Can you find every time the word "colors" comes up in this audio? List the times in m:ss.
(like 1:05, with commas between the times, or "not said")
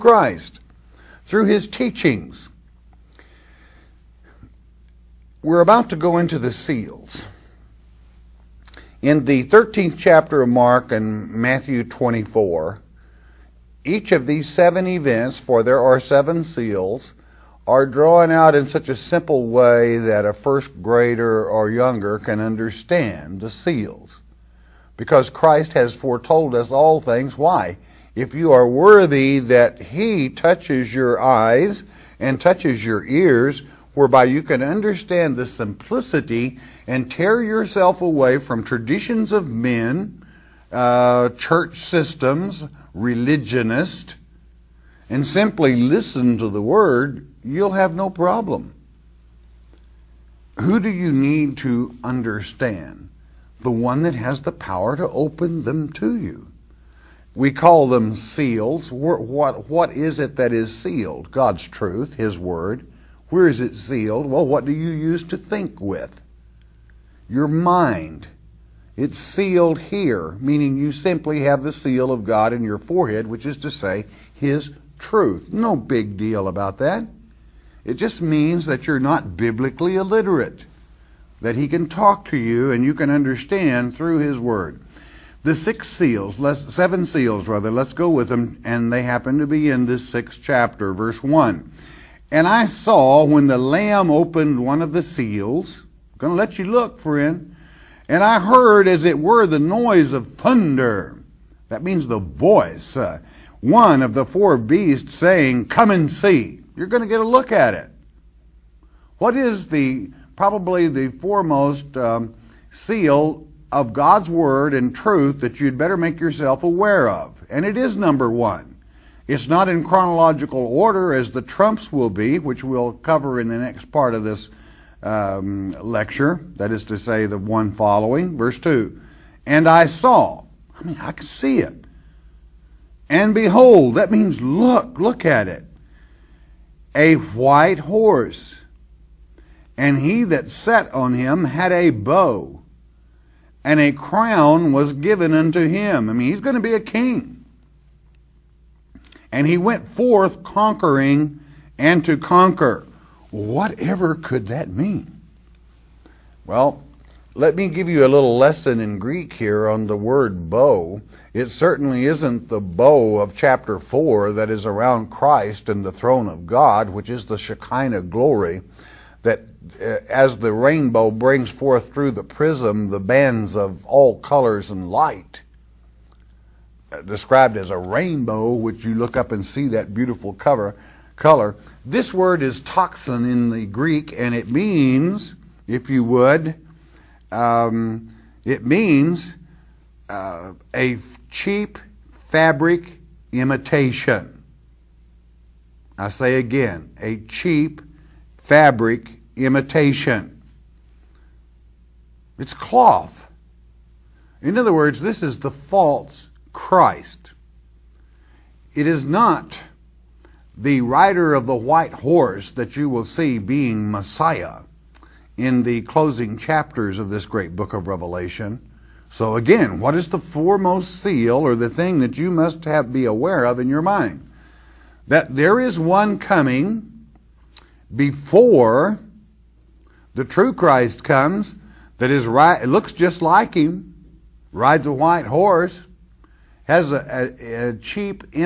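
2:54, 3:01.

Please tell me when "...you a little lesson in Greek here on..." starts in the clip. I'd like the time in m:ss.
2:37.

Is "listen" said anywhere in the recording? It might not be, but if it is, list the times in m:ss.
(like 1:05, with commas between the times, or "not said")
0:45.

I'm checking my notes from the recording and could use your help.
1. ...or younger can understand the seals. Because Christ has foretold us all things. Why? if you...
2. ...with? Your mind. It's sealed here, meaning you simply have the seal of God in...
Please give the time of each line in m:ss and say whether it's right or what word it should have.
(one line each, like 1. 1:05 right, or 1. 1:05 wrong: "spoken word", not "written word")
1. 0:21 right
2. 1:05 right.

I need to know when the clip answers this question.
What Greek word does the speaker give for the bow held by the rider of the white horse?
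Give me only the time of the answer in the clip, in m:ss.
3:02.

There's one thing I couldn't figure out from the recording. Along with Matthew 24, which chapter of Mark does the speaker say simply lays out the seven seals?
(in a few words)
13th chapter.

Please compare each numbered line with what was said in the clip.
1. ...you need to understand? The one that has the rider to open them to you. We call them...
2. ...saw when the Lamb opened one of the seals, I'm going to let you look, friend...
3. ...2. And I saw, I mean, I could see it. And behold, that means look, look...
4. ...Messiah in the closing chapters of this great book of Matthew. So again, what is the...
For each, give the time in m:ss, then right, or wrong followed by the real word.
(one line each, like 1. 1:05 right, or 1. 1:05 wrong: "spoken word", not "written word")
1. 0:50 wrong: "power", not "rider"
2. 1:32 right
3. 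2:08 right
4. 3:33 wrong: "Revelation", not "Matthew".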